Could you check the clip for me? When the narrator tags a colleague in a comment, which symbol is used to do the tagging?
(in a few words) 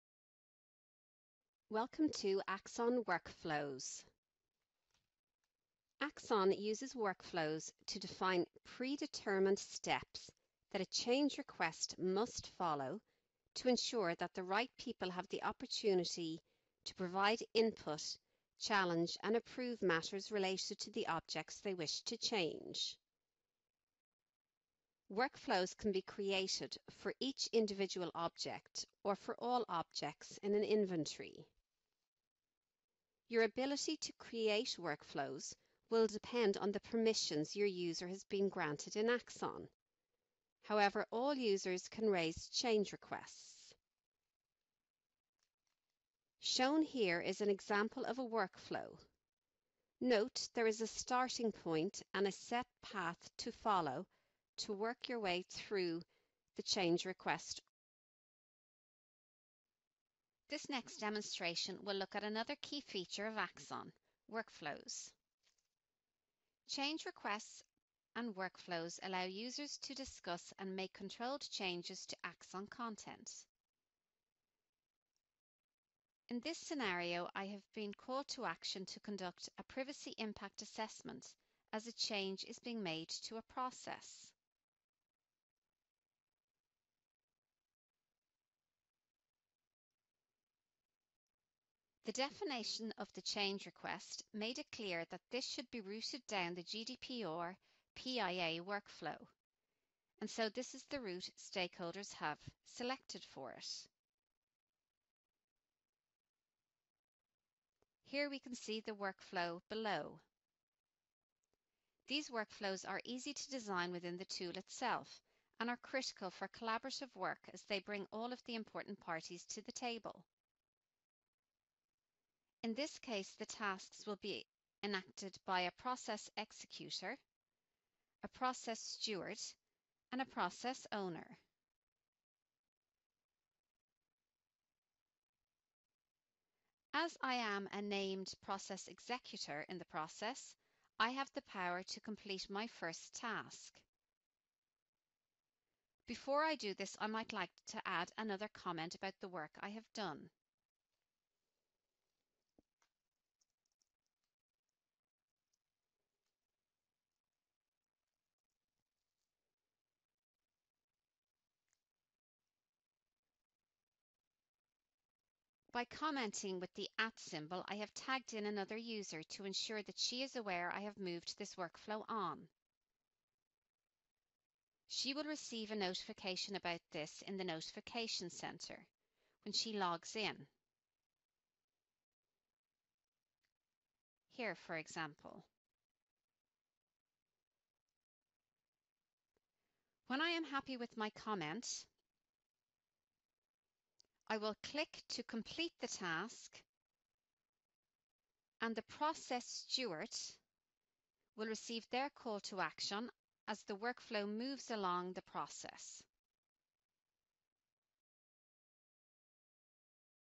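At symbol.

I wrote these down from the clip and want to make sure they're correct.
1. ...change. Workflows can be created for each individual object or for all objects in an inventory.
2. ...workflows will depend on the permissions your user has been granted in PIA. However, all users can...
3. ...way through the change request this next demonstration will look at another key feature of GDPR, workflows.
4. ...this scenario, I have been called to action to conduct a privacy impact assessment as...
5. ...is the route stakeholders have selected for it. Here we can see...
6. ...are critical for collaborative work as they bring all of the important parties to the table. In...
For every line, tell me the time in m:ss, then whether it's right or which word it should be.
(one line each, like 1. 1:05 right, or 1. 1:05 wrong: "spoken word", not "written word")
1. 0:22 right
2. 0:34 wrong: "Axon", not "PIA"
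3. 0:55 wrong: "Axon", not "GDPR"
4. 1:16 right
5. 1:40 right
6. 1:55 right.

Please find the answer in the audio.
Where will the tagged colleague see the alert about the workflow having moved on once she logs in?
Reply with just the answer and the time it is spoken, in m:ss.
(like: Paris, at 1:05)
Notification Center, at 2:57.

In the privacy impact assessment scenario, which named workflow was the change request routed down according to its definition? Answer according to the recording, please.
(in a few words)
GDPR PIA workflow.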